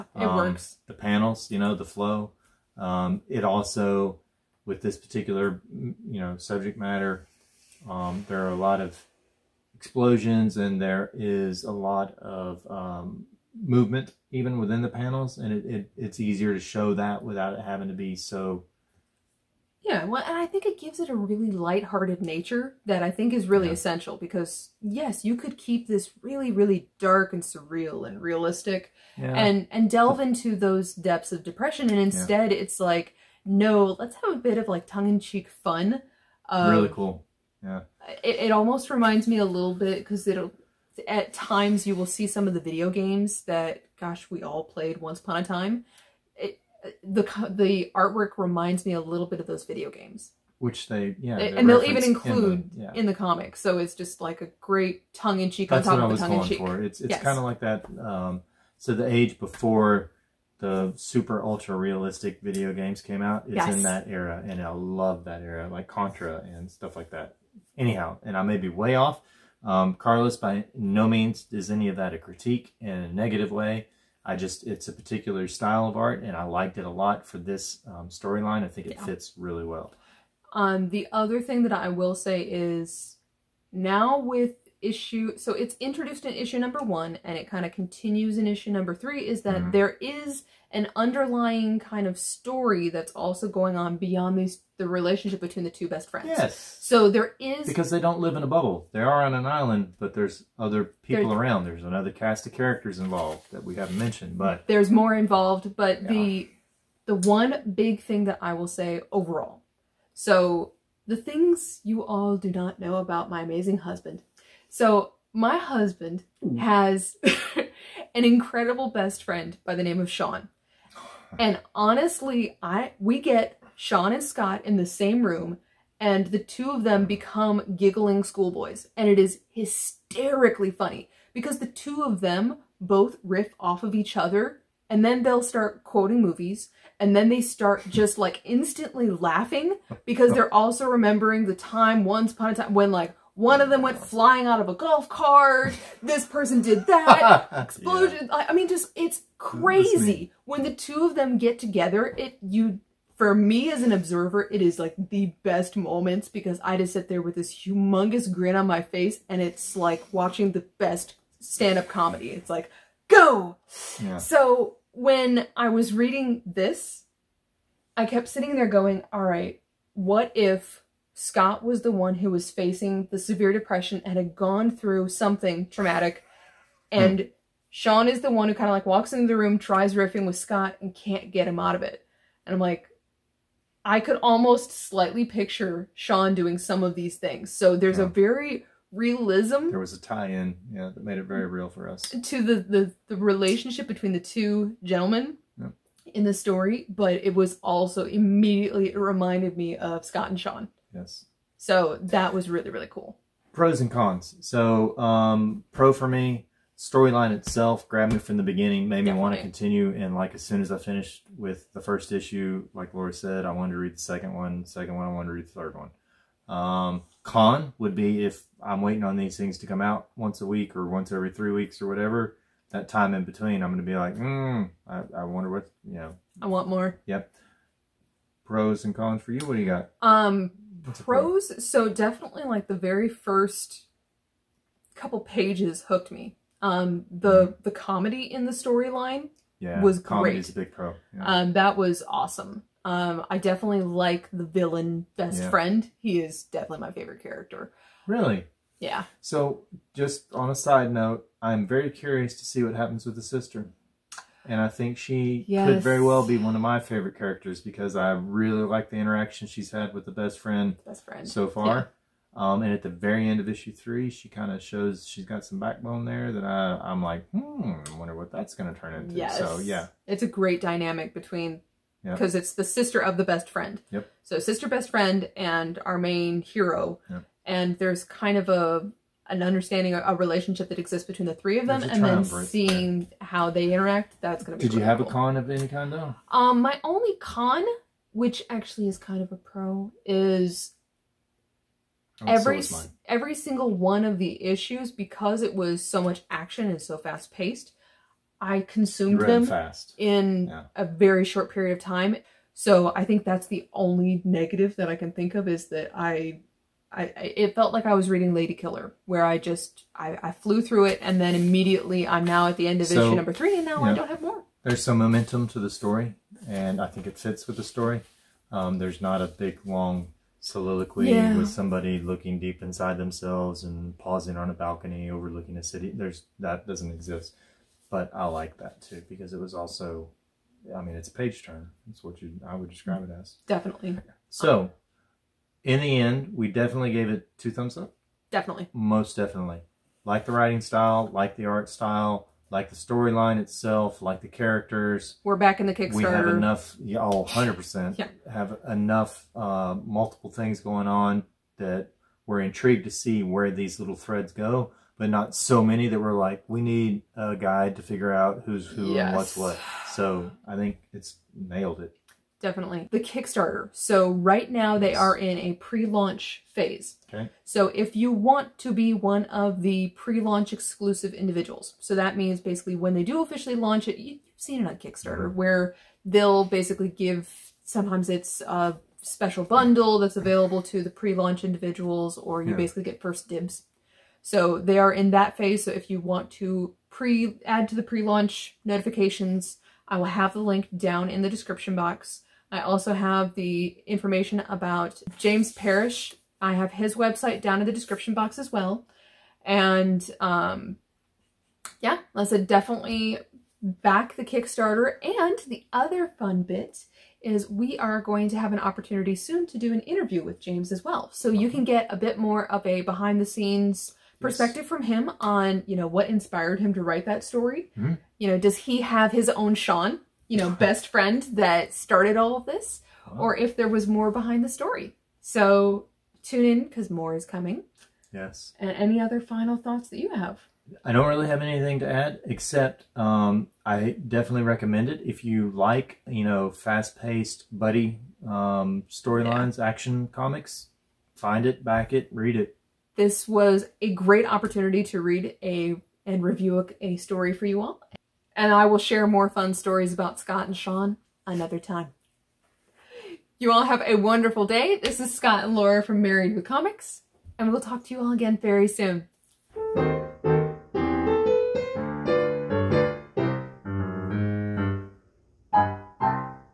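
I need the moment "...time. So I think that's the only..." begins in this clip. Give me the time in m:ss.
5:01.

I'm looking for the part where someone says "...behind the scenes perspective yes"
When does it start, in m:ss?
6:52.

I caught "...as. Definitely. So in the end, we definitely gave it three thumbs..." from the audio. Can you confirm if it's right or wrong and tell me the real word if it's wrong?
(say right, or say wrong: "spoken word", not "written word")
wrong: "two", not "three".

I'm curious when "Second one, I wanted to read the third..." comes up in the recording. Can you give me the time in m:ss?
3:34.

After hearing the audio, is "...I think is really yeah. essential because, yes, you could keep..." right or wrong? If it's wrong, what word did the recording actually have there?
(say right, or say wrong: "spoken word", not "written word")
right.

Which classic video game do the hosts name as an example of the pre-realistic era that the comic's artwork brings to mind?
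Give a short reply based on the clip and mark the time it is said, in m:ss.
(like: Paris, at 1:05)
Contra, at 1:05.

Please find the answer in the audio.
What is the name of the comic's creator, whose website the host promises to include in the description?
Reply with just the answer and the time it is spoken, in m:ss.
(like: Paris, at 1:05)
James Parrish, at 6:35.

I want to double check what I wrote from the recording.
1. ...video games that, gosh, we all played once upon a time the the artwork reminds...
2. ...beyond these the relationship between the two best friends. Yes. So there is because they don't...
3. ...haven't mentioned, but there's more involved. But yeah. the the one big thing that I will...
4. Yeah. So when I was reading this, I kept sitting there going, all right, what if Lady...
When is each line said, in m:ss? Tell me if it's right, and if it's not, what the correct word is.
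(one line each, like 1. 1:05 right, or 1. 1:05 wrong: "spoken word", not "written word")
1. 0:42 right
2. 1:33 right
3. 1:43 right
4. 2:44 wrong: "Scott", not "Lady".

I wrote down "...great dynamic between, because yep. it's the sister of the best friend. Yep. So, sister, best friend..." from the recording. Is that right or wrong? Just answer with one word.
right.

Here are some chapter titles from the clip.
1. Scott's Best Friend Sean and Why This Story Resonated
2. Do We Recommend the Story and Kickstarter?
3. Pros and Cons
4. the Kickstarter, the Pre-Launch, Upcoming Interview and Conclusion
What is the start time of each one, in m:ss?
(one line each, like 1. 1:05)
1. 1:45
2. 5:33
3. 3:22
4. 6:02.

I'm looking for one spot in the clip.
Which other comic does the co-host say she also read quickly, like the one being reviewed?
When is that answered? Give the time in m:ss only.
5:08.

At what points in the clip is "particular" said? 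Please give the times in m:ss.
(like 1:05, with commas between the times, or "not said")
0:04, 1:14.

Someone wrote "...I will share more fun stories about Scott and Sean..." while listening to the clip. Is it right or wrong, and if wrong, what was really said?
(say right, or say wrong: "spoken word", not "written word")
right.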